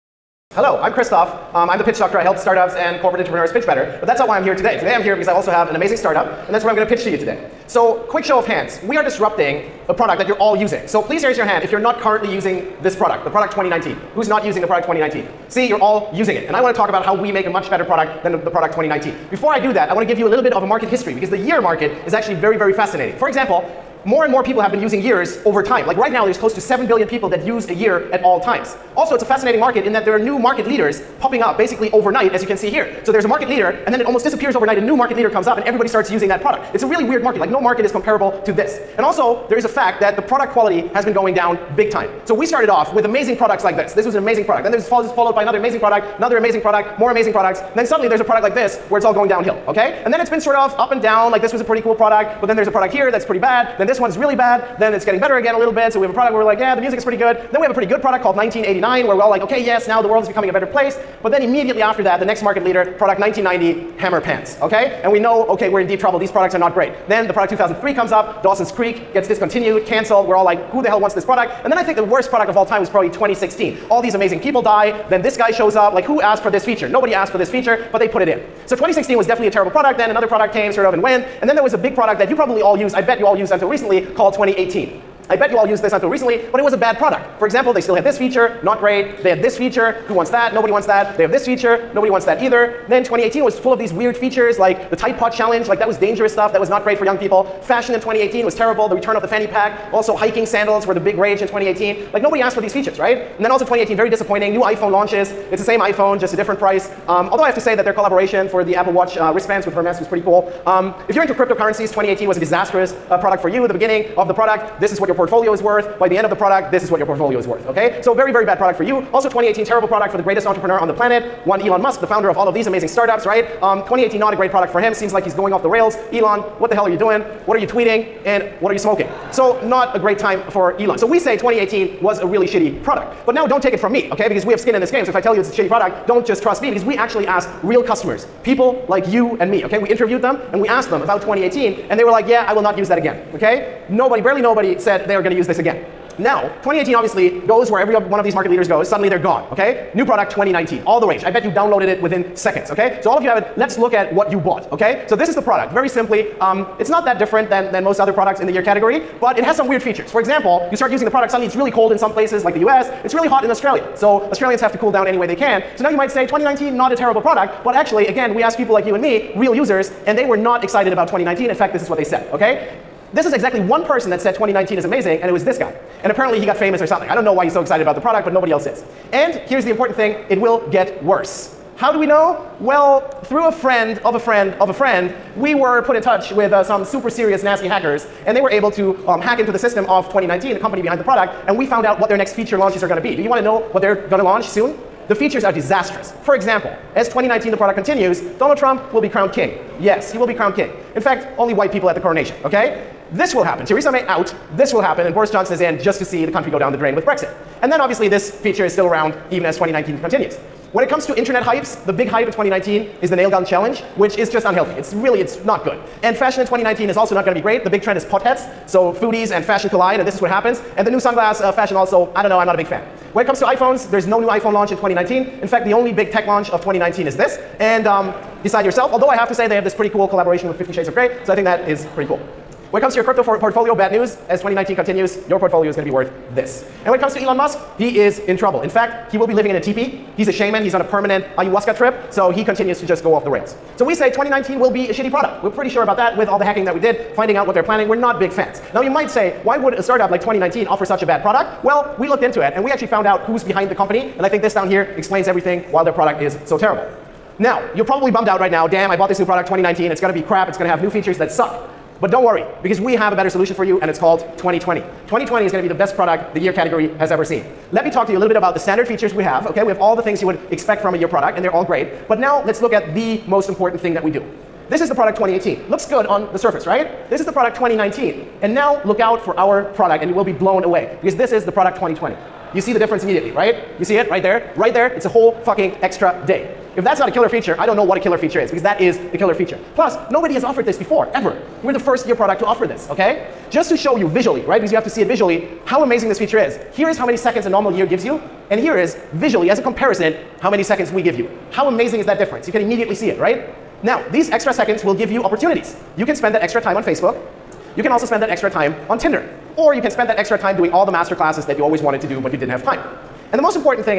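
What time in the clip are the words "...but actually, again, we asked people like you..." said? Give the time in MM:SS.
02:47.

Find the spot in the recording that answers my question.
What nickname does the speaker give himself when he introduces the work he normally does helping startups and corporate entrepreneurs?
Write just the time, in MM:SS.
00:01.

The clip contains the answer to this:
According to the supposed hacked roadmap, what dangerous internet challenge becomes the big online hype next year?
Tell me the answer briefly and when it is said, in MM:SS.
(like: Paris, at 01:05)
nail gun challenge, at 03:33.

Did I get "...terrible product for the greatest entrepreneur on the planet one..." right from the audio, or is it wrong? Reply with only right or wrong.
right.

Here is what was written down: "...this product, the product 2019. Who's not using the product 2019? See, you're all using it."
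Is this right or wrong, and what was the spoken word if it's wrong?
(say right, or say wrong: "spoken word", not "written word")
right.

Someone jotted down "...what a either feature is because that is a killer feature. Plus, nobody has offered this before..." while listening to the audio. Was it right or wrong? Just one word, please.
wrong.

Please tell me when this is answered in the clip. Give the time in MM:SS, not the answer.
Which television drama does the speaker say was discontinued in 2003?
01:08.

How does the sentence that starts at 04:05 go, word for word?
We're pretty sure about that with all the hacking that we did, finding out what they're planning.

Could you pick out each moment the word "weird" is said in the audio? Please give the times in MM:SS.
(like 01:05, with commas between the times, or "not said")
00:37, 01:33, 02:39.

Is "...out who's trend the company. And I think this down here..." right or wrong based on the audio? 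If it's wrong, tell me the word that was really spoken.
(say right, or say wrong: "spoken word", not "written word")
wrong: "behind", not "trend".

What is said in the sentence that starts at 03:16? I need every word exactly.
For example, as 2019 the product continues, Donald Trump will be crowned king.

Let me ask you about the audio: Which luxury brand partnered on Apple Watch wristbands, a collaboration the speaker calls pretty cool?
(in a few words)
Hermes.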